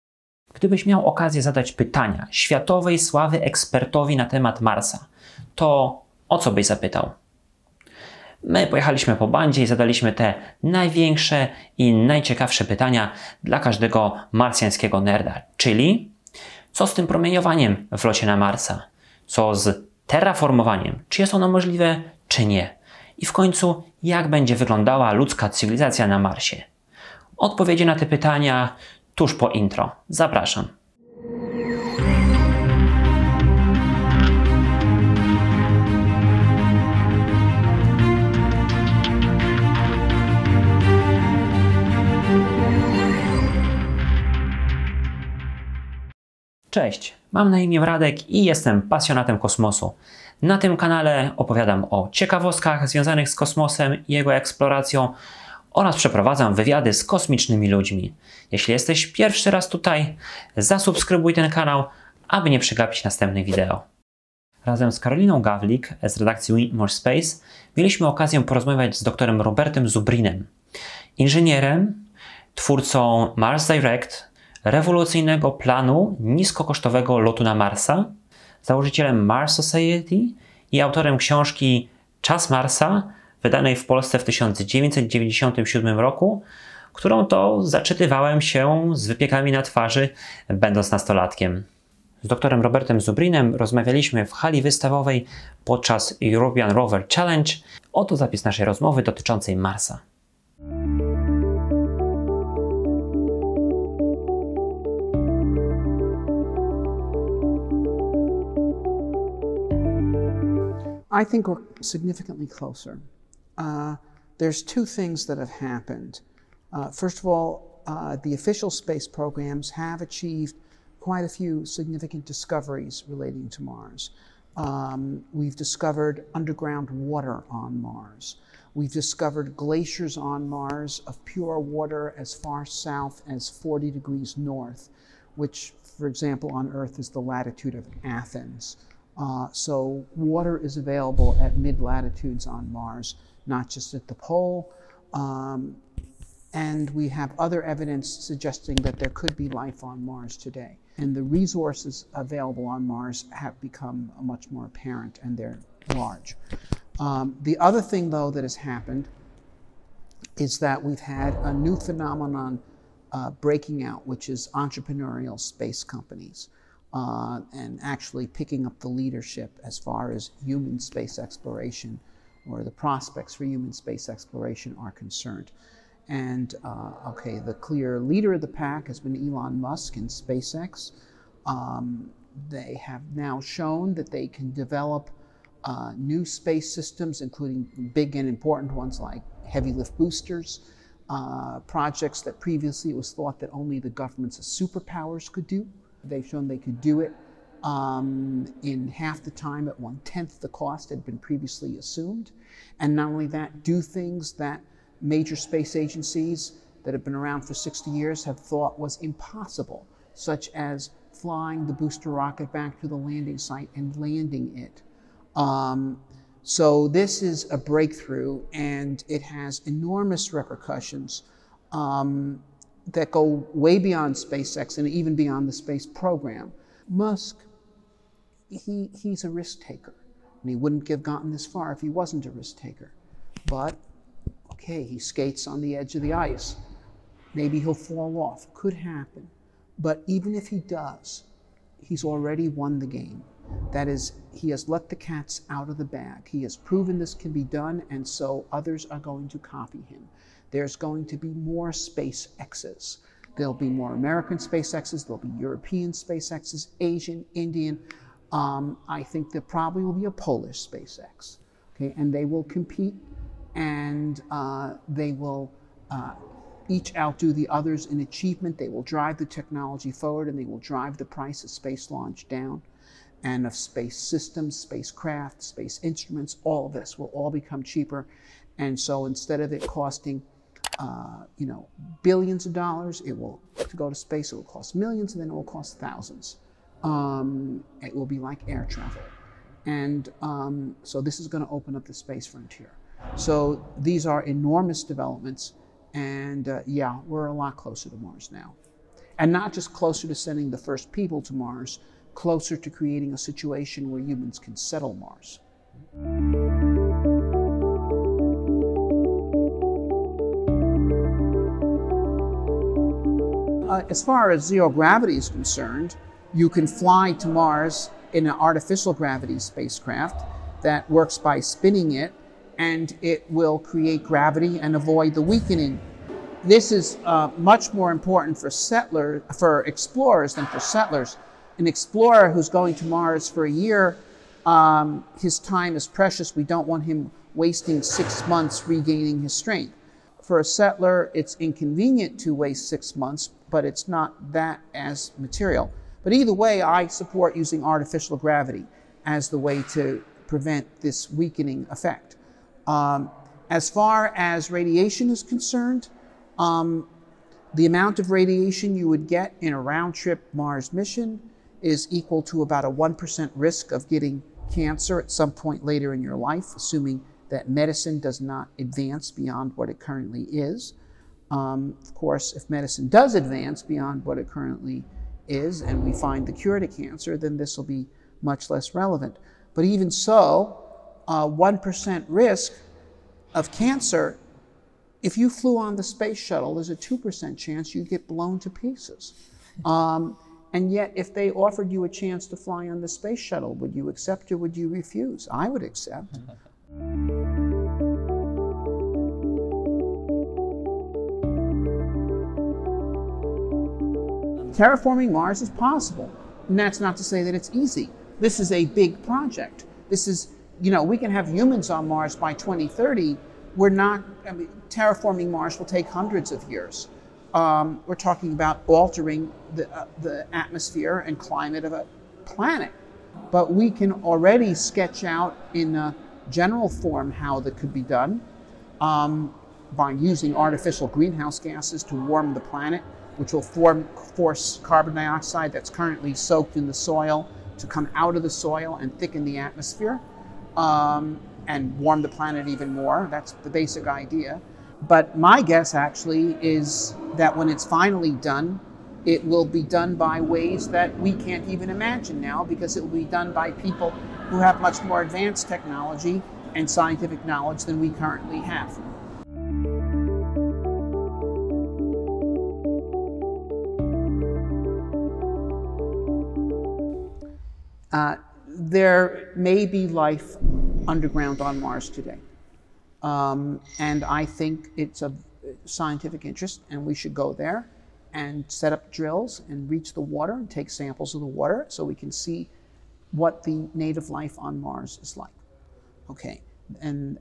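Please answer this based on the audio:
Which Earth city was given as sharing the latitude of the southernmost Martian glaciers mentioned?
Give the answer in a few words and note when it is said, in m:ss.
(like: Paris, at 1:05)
Athens, at 2:18.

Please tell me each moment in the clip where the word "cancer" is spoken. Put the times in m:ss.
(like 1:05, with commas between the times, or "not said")
6:04, 6:16, 6:23.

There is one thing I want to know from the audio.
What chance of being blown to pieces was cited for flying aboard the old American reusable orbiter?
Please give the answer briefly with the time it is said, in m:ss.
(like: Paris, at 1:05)
2%, at 6:26.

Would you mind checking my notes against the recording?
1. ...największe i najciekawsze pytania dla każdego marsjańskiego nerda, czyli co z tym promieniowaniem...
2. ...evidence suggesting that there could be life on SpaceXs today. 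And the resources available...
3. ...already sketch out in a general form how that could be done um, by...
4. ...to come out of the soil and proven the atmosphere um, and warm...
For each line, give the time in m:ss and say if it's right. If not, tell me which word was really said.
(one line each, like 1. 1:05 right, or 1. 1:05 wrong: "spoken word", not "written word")
1. 0:10 right
2. 2:27 wrong: "Mars", not "SpaceXs"
3. 7:04 right
4. 7:17 wrong: "thicken", not "proven".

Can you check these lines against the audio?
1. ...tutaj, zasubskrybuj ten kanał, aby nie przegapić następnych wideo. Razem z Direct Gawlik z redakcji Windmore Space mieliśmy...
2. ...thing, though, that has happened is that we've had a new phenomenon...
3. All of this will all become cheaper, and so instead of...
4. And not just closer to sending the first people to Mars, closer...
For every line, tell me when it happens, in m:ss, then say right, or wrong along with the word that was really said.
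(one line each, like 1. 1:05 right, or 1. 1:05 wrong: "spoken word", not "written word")
1. 0:59 wrong: "Karoliną", not "Direct"
2. 2:37 right
3. 4:36 right
4. 4:59 right.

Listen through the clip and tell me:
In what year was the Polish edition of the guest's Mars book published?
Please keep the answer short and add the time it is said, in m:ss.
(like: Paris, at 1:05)
1997, at 1:24.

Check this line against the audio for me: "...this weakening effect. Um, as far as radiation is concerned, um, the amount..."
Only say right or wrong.
right.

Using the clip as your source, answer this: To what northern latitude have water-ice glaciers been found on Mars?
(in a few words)
40 degrees north.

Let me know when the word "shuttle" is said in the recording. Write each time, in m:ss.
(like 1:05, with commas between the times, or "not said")
6:26, 6:33.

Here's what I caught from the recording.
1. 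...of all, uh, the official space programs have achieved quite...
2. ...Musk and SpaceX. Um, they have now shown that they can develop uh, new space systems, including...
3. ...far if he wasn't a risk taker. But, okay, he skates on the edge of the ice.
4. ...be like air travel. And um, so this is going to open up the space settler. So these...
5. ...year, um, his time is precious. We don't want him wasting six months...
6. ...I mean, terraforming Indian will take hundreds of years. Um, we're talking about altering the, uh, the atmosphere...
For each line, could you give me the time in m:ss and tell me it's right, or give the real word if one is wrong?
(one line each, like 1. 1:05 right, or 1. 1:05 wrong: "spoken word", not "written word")
1. 1:57 right
2. 2:59 right
3. 3:51 right
4. 4:48 wrong: "frontier", not "settler"
5. 5:33 right
6. 6:54 wrong: "Mars", not "Indian".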